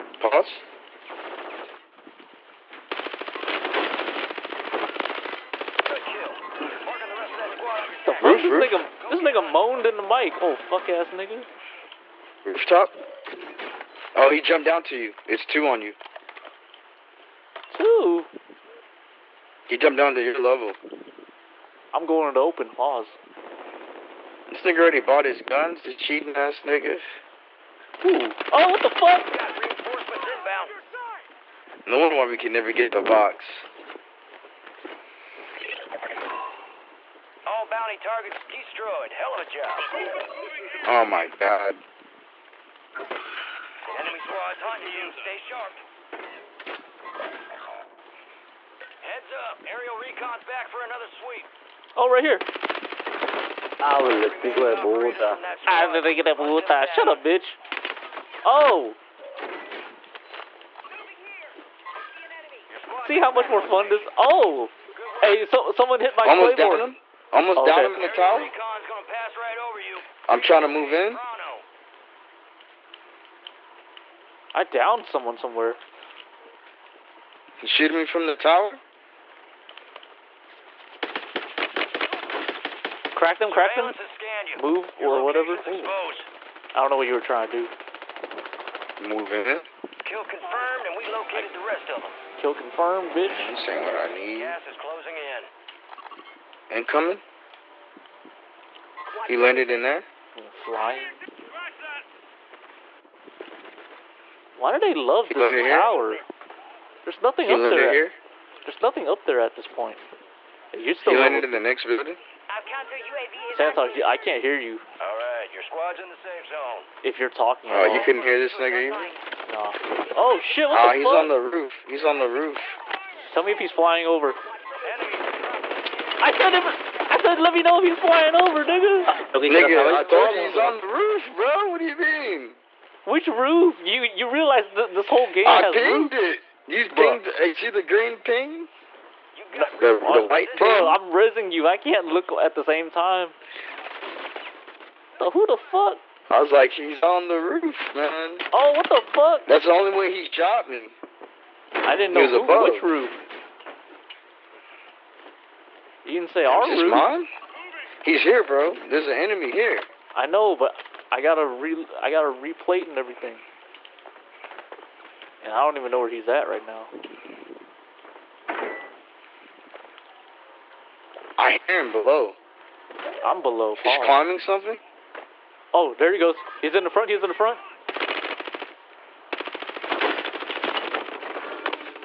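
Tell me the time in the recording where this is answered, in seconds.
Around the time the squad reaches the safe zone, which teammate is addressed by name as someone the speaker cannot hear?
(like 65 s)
113 s.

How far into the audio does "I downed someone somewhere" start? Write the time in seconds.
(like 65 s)
74 s.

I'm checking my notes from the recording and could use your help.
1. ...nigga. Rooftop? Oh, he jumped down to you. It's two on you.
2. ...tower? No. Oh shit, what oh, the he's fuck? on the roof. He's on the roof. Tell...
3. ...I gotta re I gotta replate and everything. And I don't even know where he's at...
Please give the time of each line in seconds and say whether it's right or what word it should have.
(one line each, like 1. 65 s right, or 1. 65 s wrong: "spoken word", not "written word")
1. 11 s right
2. 118 s wrong: "either", not "tower"
3. 161 s right.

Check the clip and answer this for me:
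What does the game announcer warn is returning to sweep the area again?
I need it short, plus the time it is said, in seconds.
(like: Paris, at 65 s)
Aerial recon, at 49 s.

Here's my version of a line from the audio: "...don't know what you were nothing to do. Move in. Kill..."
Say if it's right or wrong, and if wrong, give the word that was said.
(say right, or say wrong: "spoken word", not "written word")
wrong: "trying", not "nothing".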